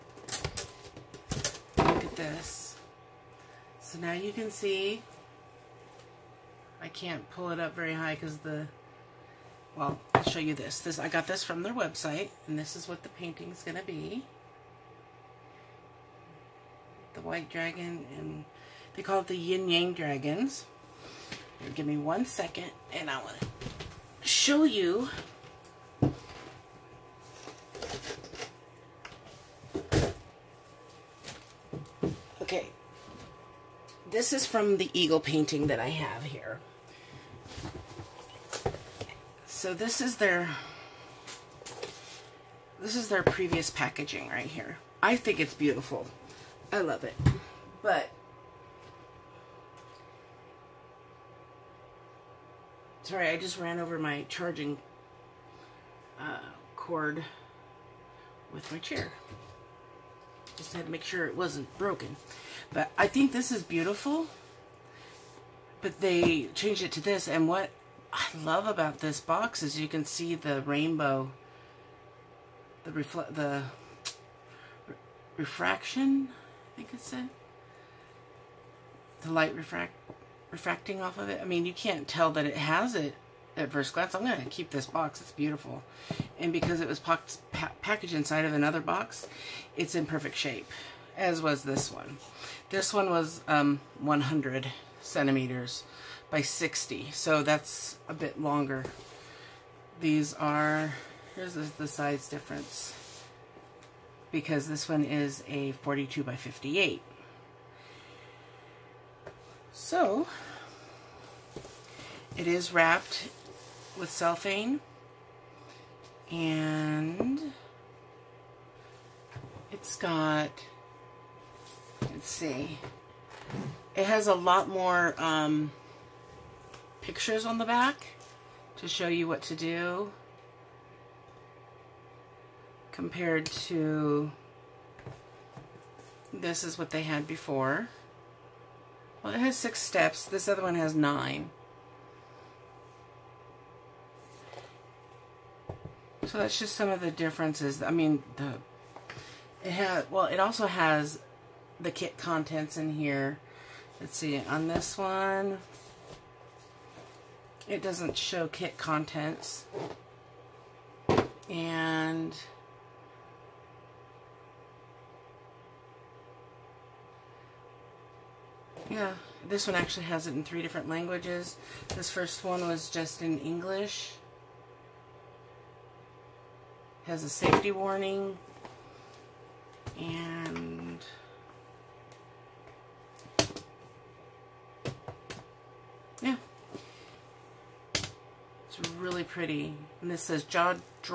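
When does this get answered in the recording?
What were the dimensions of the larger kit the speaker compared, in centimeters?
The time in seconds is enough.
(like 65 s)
93 s.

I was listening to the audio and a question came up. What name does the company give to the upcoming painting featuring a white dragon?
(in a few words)
yin-yang dragons.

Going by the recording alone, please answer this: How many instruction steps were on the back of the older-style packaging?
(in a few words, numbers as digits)
6.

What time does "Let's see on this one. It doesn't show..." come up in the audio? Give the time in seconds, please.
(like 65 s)
153 s.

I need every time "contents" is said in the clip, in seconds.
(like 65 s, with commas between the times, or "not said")
152 s, 158 s.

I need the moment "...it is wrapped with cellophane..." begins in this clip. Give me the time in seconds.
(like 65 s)
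112 s.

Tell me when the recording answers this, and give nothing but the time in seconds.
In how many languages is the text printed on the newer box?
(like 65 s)
170 s.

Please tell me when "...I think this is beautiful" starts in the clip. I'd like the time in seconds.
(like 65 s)
62 s.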